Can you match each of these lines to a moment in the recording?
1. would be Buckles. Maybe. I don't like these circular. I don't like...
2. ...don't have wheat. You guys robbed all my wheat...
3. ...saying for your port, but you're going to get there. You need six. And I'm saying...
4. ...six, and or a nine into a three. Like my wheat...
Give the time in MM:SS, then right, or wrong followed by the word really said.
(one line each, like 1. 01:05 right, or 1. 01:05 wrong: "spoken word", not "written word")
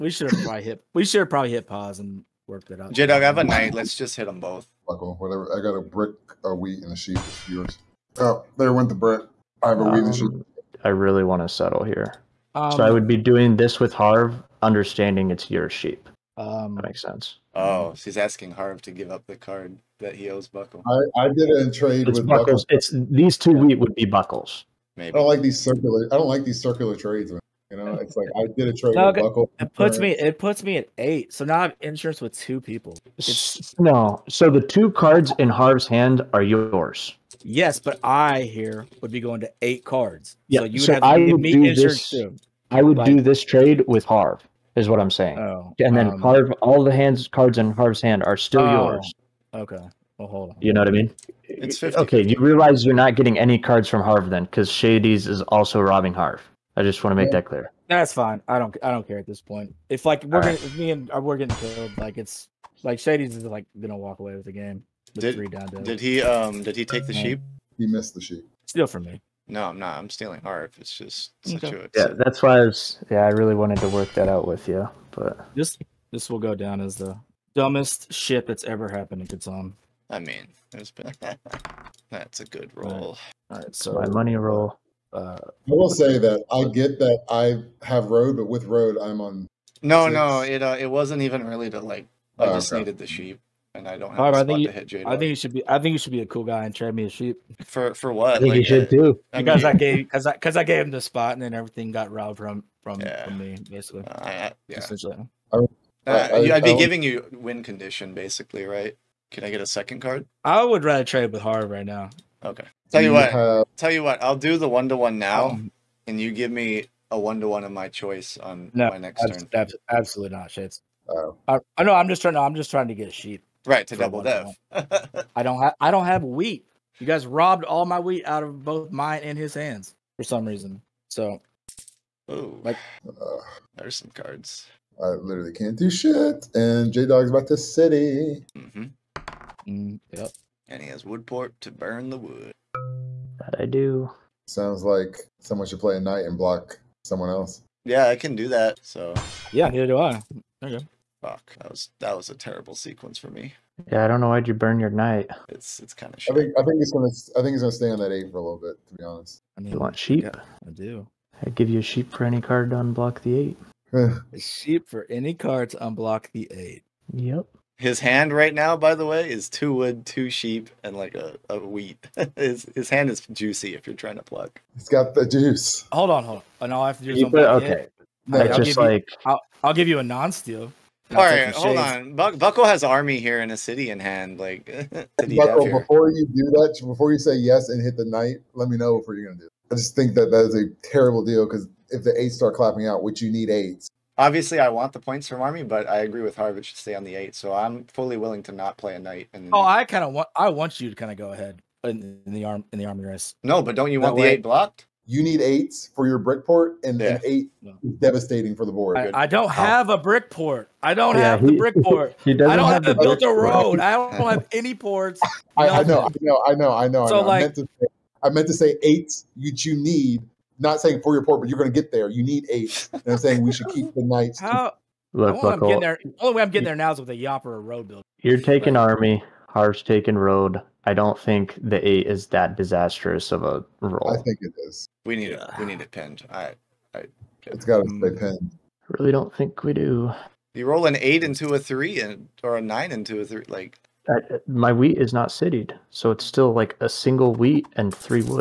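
1. 00:23 right
2. 02:05 right
3. 03:40 wrong: "eight", not "six"
4. 04:01 wrong: "three", not "six".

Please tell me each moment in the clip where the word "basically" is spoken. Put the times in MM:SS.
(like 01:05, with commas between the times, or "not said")
01:43, 01:48.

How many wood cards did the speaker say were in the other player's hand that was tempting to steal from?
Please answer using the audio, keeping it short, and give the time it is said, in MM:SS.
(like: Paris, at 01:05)
2, at 02:49.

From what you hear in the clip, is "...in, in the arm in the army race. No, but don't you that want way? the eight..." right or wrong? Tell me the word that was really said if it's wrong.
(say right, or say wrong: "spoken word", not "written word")
right.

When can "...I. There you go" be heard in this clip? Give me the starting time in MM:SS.
02:29.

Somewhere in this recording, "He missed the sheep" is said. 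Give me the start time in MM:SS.
01:07.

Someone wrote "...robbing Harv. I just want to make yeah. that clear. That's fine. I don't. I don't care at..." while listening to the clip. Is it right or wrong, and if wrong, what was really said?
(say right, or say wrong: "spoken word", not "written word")
right.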